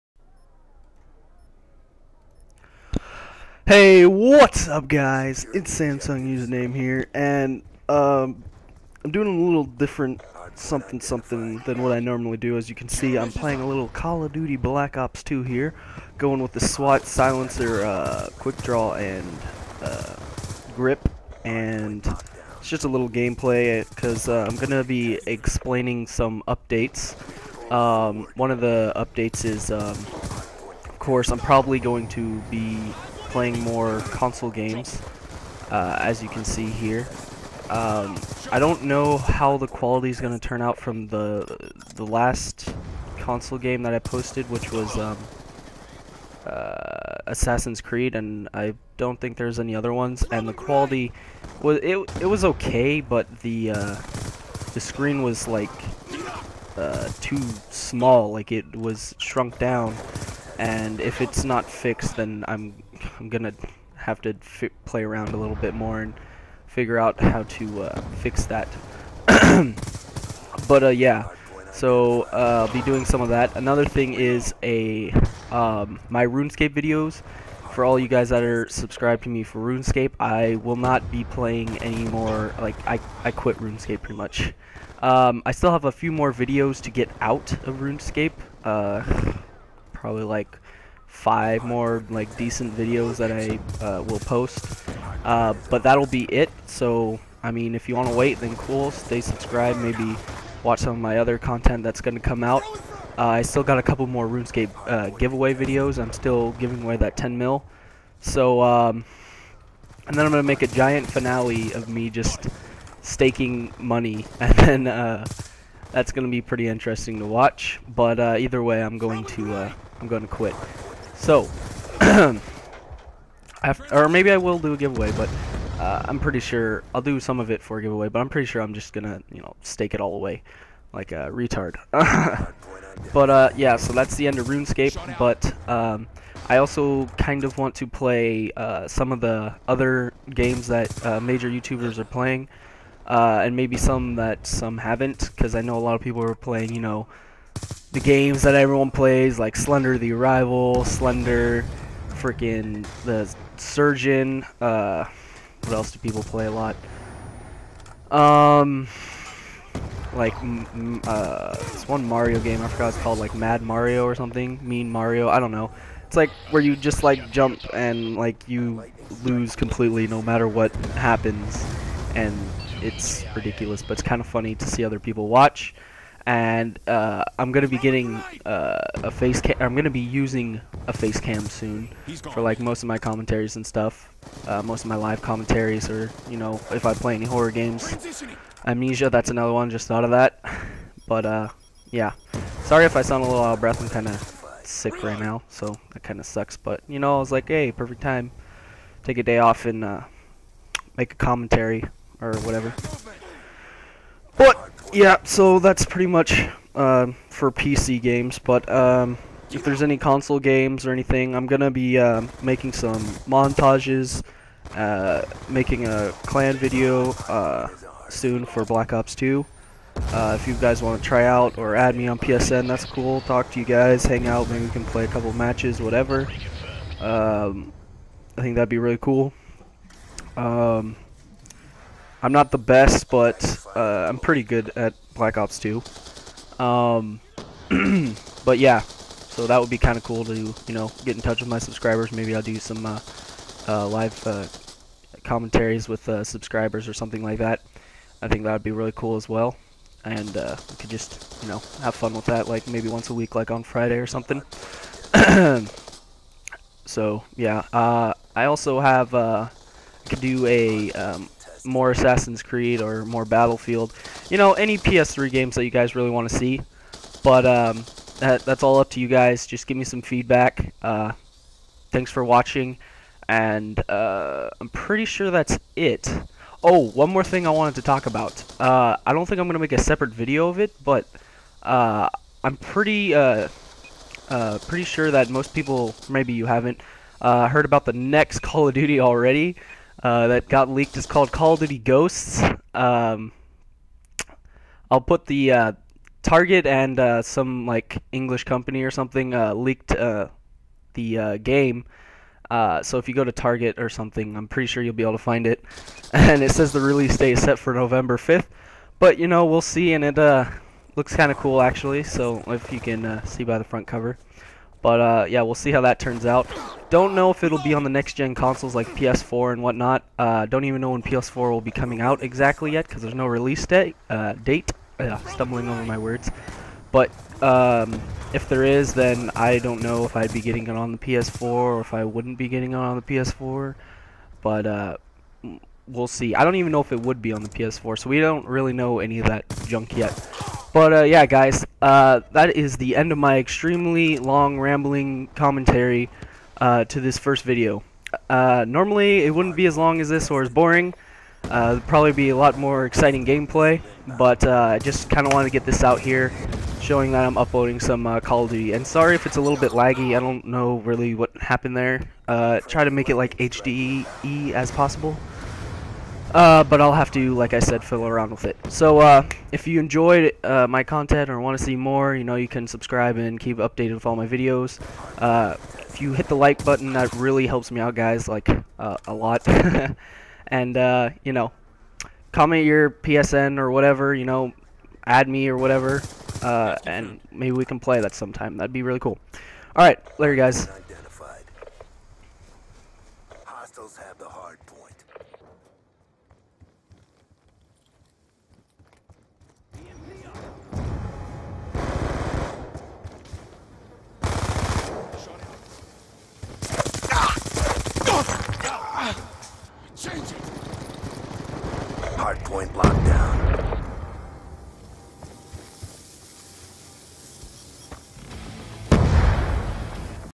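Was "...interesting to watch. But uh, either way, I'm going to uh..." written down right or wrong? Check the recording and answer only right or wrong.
right.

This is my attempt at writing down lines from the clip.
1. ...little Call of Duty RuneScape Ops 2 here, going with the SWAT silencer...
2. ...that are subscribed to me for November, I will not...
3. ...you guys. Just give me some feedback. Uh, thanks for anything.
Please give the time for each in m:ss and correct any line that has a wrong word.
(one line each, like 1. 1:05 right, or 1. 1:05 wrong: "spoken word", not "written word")
1. 0:13 wrong: "Black", not "RuneScape"
2. 1:18 wrong: "RuneScape", not "November"
3. 4:28 wrong: "watching", not "anything".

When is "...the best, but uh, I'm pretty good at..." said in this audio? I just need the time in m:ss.
3:52.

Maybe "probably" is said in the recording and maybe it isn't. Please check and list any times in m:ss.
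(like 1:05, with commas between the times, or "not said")
0:31, 1:29, 5:51.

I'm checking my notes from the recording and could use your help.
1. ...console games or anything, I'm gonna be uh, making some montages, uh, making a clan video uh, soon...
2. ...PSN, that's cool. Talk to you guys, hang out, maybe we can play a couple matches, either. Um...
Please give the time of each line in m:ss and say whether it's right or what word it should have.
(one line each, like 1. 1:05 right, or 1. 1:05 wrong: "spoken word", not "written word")
1. 3:29 right
2. 3:42 wrong: "whatever", not "either".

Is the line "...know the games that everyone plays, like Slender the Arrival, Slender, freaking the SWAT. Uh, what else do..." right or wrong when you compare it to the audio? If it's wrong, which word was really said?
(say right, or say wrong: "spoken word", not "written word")
wrong: "Surgeon", not "SWAT".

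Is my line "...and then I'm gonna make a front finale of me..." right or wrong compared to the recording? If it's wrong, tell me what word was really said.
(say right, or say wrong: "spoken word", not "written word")
wrong: "giant", not "front".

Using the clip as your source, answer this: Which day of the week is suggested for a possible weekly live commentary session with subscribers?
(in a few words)
Friday.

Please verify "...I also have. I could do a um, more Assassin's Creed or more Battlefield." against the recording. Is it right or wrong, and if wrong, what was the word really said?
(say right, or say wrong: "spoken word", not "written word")
right.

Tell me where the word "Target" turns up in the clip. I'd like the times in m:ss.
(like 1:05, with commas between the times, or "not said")
4:56, 5:03.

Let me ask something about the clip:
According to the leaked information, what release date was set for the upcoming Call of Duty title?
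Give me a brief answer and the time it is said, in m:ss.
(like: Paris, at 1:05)
November 5th, at 5:07.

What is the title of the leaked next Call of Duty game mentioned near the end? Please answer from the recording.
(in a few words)
Call of Duty Ghosts.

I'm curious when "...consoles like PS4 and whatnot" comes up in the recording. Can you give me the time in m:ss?
5:18.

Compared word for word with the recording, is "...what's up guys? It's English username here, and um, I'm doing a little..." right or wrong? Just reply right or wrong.
wrong.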